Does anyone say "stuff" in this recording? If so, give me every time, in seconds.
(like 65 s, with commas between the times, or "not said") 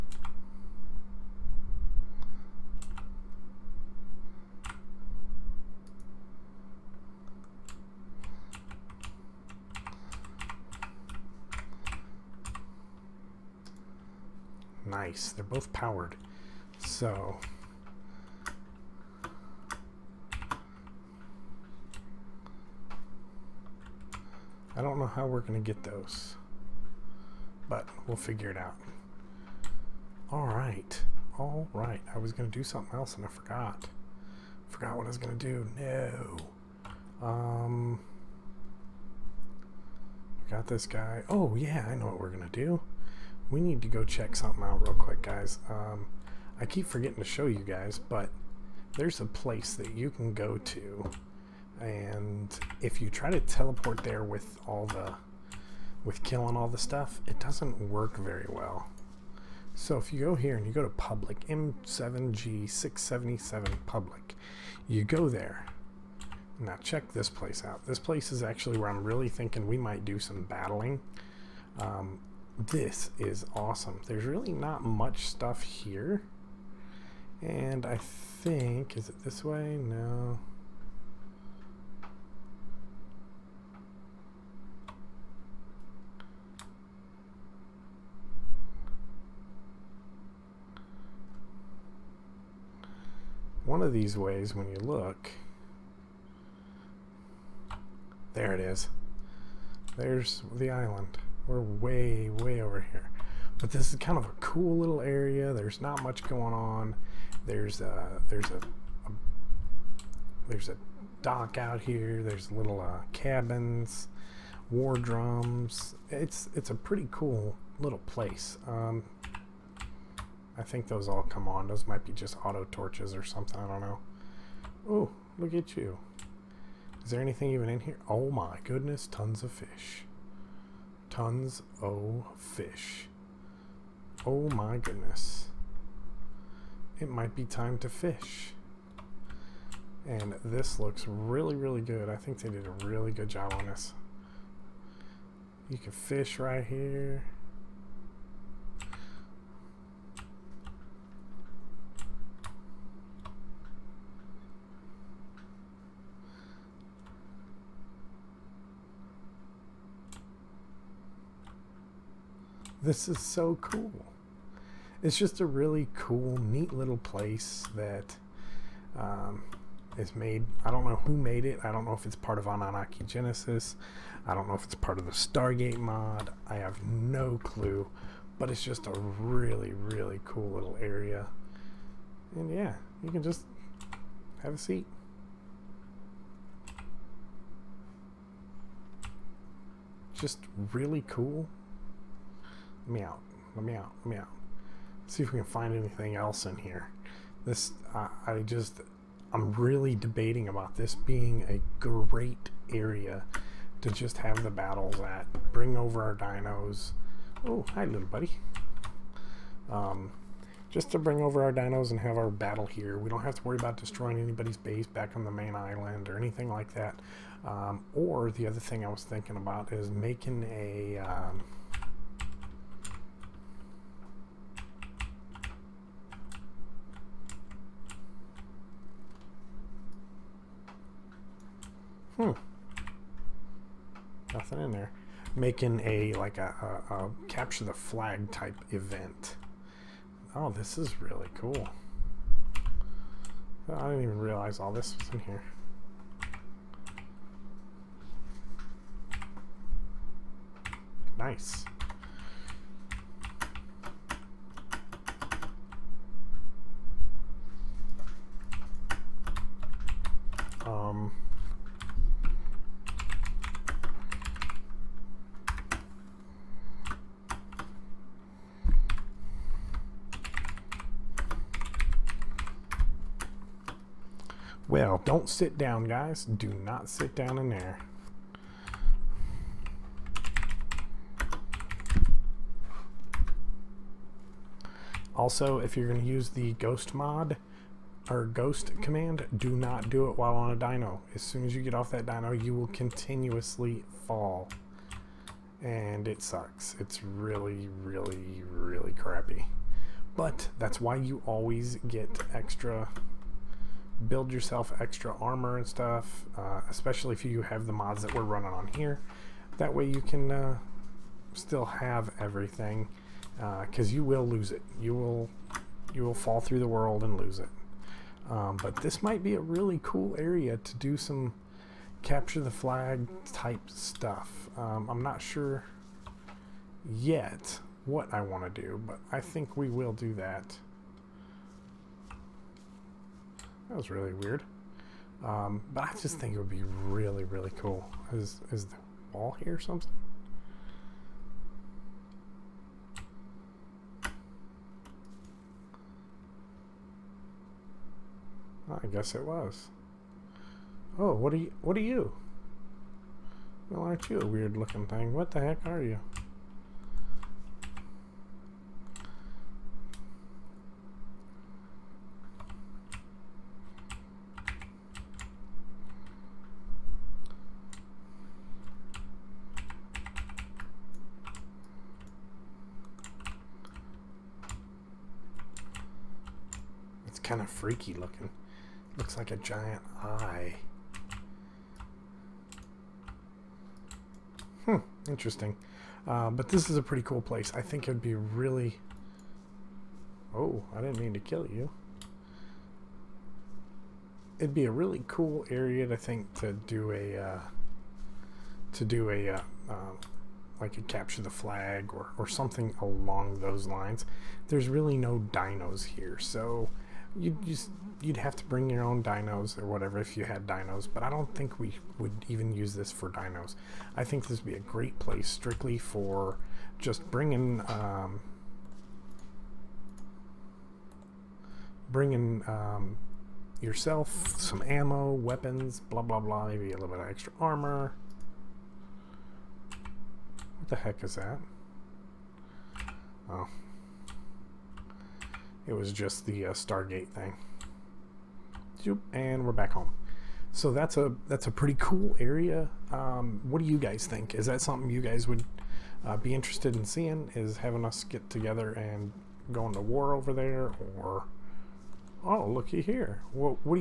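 56 s, 75 s, 305 s, 323 s.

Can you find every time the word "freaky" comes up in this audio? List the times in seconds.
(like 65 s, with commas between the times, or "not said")
377 s.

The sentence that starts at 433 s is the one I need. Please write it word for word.
Oh, it was just the uh, Stargate thing.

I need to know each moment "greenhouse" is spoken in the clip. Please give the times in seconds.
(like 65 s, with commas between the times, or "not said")
not said.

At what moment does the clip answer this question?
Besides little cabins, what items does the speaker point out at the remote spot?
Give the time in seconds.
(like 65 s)
114 s.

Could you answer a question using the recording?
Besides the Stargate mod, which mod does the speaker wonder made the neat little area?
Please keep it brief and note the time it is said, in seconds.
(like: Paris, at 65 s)
Annunaki Genesis, at 172 s.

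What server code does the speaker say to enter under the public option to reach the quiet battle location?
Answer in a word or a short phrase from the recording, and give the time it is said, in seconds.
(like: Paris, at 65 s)
M7G677, at 61 s.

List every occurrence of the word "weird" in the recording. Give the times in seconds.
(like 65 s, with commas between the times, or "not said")
334 s, 354 s.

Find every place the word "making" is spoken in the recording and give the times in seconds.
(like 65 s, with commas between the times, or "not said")
219 s, 235 s.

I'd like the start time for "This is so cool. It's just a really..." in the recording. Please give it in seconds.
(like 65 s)
162 s.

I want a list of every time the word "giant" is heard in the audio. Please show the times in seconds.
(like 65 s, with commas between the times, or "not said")
379 s.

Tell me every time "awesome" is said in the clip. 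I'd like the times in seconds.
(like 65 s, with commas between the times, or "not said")
73 s.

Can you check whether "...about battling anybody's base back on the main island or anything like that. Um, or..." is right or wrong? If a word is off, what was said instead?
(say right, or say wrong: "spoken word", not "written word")
wrong: "destroying", not "battling".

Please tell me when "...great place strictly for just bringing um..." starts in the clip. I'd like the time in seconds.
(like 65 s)
414 s.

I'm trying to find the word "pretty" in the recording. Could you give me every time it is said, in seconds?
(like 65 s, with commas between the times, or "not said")
116 s, 386 s, 441 s.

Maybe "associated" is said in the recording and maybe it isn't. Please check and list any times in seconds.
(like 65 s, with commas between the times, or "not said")
not said.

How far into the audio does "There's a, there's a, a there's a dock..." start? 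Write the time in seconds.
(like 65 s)
107 s.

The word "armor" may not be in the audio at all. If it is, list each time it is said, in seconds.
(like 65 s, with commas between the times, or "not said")
305 s, 427 s.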